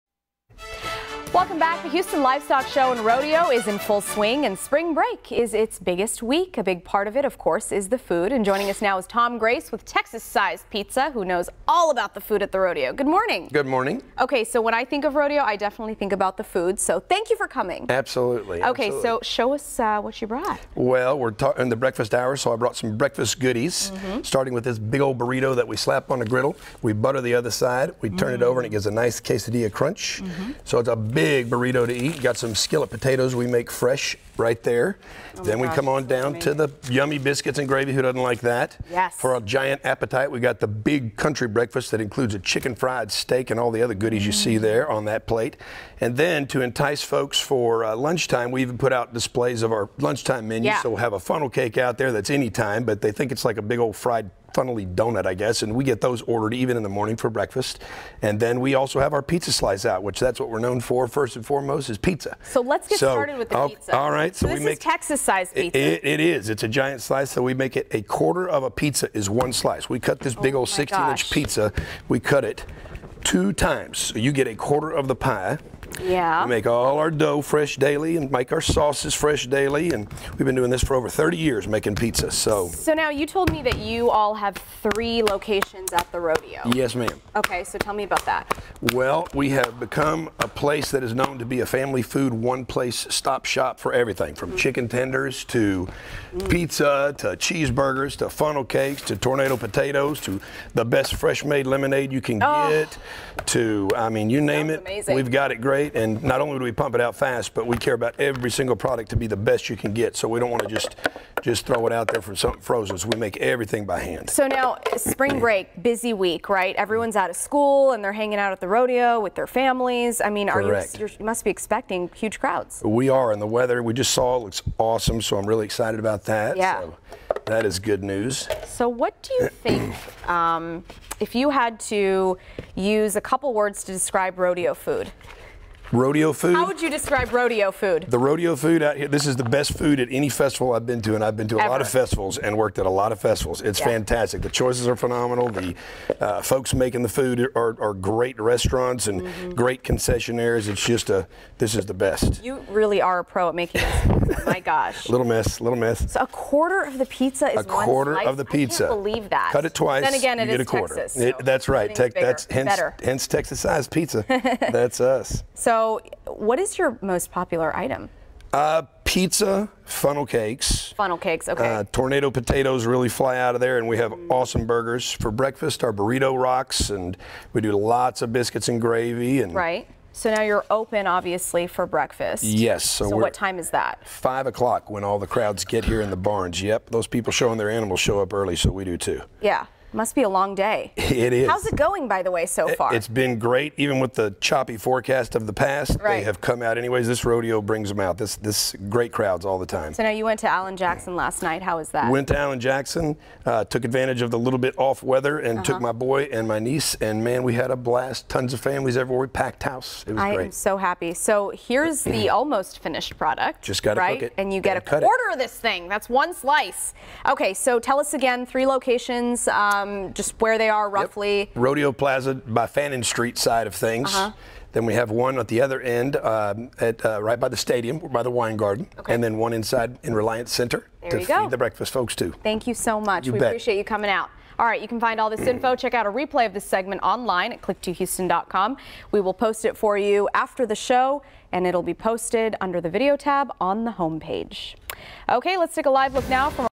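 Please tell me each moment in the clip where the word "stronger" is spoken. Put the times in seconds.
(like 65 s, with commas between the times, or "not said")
not said.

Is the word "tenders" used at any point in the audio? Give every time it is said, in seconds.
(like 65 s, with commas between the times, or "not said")
94 s.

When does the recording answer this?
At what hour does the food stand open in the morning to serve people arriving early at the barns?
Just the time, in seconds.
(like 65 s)
184 s.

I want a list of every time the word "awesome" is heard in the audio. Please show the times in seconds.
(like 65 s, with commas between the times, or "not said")
124 s, 174 s.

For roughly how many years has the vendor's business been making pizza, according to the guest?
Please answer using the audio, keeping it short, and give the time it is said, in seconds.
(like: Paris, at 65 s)
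over 30 years, at 80 s.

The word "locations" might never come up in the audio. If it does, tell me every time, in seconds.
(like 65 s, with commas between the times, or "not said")
85 s, 218 s.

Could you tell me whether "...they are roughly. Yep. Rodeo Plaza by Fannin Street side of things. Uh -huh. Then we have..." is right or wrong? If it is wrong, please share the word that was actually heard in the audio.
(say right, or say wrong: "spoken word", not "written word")
right.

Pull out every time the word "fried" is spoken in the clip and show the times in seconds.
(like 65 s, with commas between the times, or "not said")
42 s, 53 s.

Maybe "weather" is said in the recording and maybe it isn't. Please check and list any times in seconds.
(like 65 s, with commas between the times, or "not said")
123 s, 205 s.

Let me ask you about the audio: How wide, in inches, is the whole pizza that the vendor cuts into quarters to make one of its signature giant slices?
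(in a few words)
16 inches.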